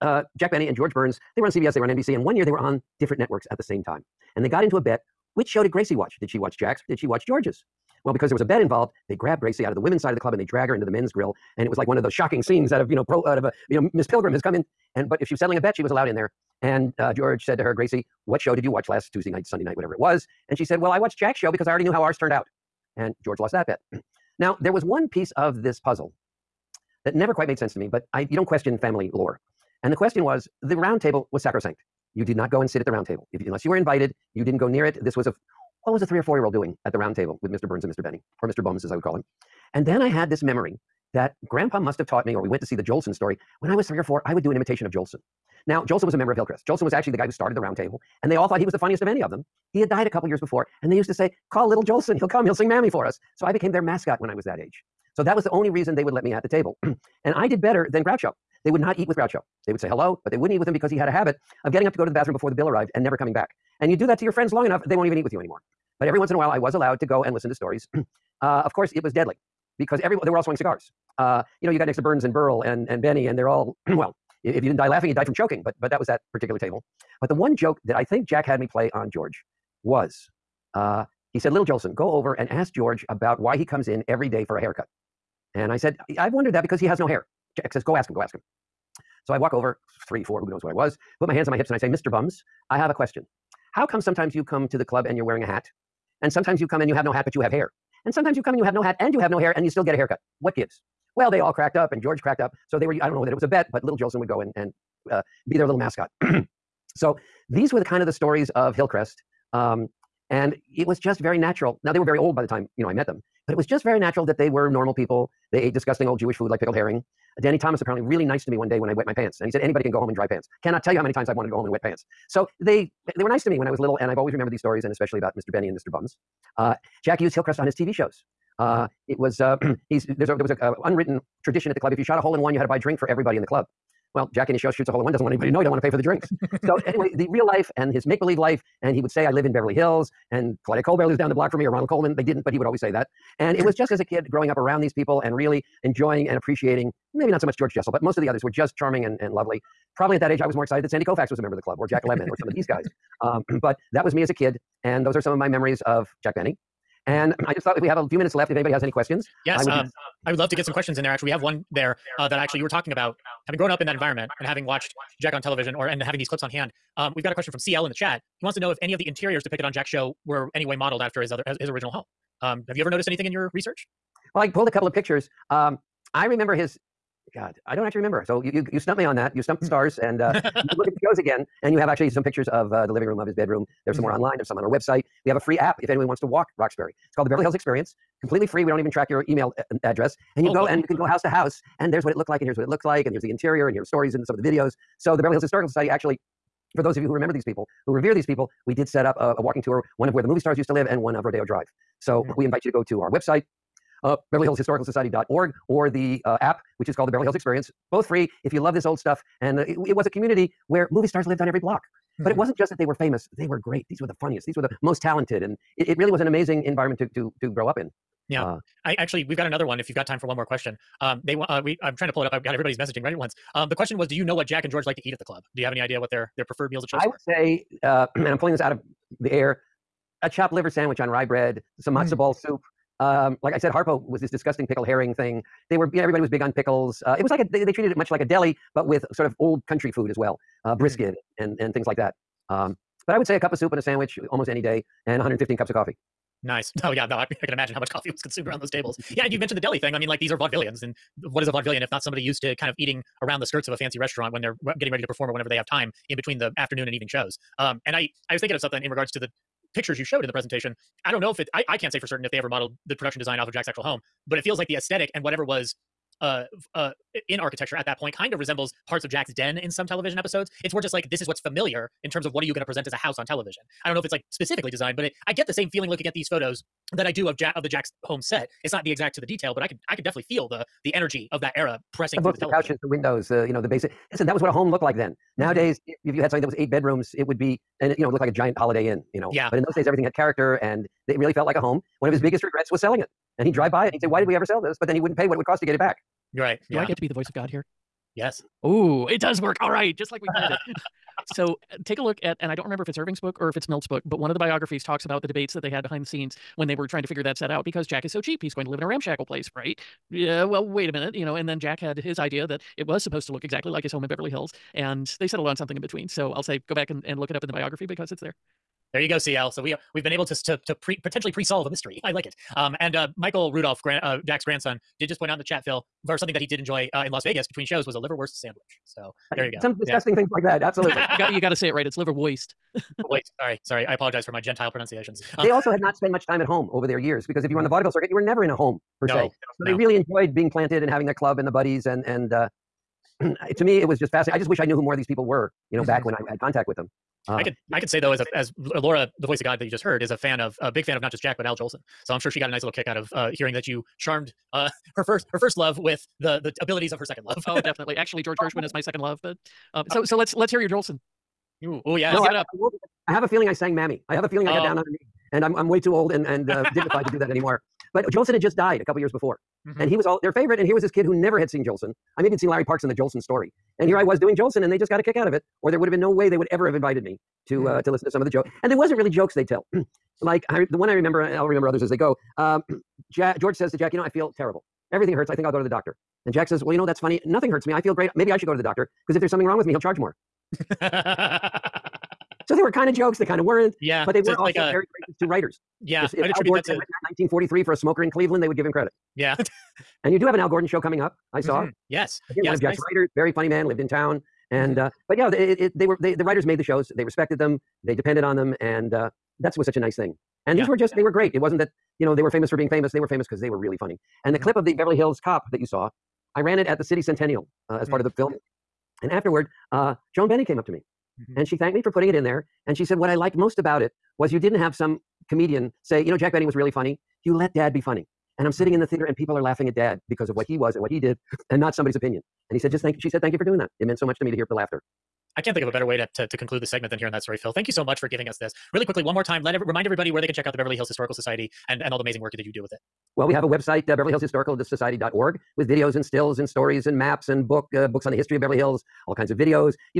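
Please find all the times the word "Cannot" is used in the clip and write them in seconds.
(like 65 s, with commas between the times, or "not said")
120 s.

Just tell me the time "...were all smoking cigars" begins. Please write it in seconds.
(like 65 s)
70 s.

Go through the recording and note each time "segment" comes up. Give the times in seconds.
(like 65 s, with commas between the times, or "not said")
436 s.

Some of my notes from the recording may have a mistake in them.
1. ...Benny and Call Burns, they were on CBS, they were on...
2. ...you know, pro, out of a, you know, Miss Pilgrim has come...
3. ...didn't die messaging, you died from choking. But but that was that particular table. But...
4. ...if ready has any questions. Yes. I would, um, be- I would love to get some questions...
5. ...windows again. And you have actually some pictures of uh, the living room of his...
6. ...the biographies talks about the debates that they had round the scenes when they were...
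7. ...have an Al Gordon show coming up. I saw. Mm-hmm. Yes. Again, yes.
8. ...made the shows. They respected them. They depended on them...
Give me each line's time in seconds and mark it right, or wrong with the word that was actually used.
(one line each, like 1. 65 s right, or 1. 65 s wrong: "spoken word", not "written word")
1. 0 s wrong: "George", not "Call"
2. 12 s right
3. 74 s wrong: "laughing", not "messaging"
4. 158 s wrong: "anybody", not "ready"
5. 181 s wrong: "shows", not "windows"
6. 304 s wrong: "behind", not "round"
7. 400 s right
8. 406 s right.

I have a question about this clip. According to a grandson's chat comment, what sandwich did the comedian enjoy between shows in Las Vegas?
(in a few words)
liverwurst sandwich.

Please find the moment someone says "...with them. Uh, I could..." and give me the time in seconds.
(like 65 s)
346 s.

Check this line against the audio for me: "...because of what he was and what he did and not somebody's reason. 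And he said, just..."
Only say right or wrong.
wrong.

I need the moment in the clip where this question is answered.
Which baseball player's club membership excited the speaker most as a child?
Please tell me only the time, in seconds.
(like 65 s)
150 s.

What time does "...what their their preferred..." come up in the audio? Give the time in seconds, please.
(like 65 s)
225 s.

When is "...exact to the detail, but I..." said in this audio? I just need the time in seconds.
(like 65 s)
278 s.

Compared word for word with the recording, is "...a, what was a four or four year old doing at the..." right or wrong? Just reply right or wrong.
wrong.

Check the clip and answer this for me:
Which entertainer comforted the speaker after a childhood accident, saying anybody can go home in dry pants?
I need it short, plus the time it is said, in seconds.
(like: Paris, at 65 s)
Danny Thomas, at 117 s.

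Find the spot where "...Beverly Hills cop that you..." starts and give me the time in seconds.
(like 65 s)
414 s.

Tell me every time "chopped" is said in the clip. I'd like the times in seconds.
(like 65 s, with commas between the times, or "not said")
230 s.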